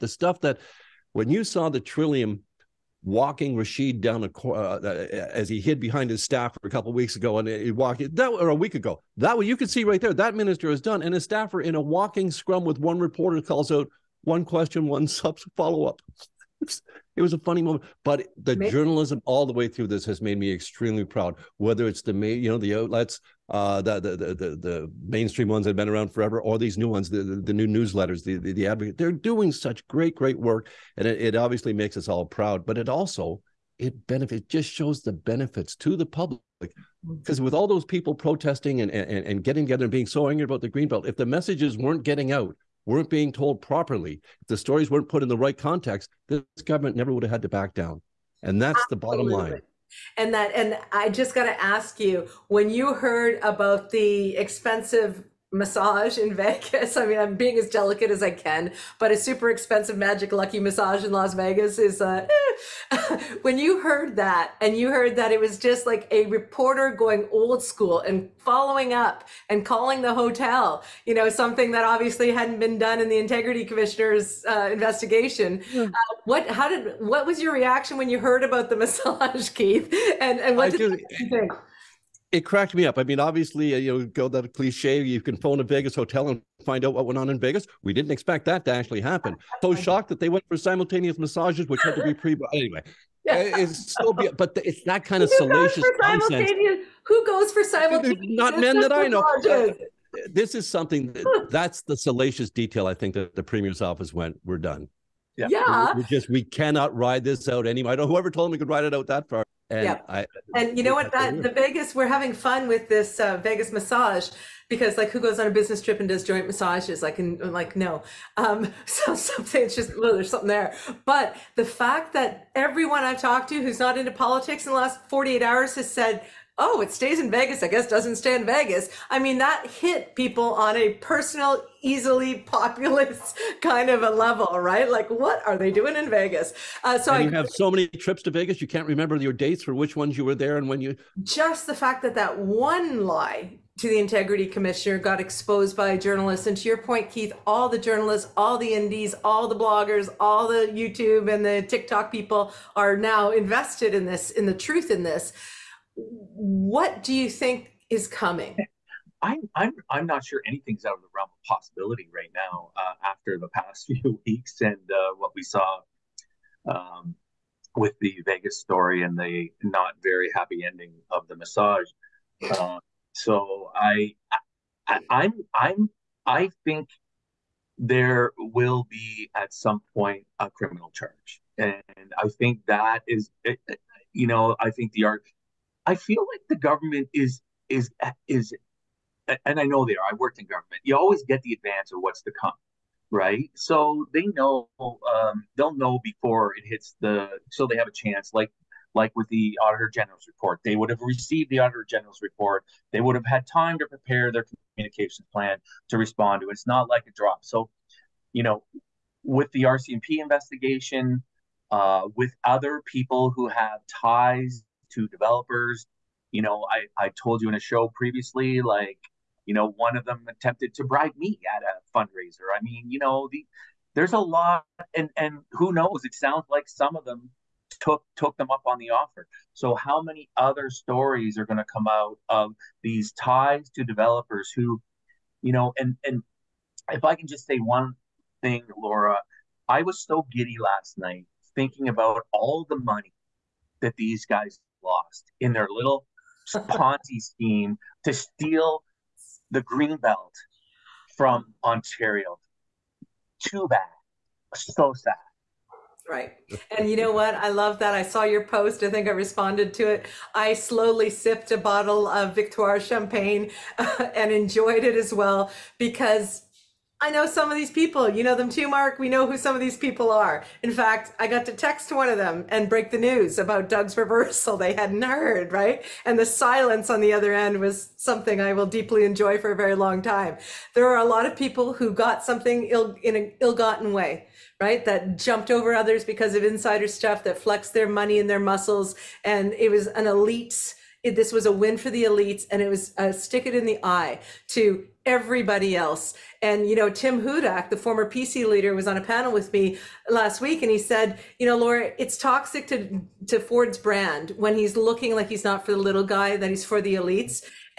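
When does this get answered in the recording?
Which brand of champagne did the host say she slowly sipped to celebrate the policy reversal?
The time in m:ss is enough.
4:22.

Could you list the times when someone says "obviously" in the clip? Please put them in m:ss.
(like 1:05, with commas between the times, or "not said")
0:31, 1:11, 1:23.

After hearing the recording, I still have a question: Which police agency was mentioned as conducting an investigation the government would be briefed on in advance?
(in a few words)
RCMP.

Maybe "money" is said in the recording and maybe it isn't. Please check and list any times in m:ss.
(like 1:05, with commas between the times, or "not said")
4:02, 4:47.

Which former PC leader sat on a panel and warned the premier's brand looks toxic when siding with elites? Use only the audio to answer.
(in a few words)
Tim Hudak.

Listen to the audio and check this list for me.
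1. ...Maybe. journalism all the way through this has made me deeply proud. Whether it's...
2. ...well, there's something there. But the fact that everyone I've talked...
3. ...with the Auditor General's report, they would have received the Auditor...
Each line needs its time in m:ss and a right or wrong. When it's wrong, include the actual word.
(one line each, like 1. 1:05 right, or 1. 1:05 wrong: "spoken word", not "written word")
1. 0:18 wrong: "extremely", not "deeply"
2. 1:59 right
3. 3:19 right.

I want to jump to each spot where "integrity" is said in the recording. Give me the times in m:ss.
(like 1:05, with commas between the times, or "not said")
1:13, 2:23.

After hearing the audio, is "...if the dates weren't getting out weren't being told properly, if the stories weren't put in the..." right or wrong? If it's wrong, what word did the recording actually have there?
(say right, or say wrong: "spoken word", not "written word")
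wrong: "messages", not "dates".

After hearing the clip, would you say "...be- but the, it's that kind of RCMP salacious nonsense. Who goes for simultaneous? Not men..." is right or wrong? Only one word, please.
wrong.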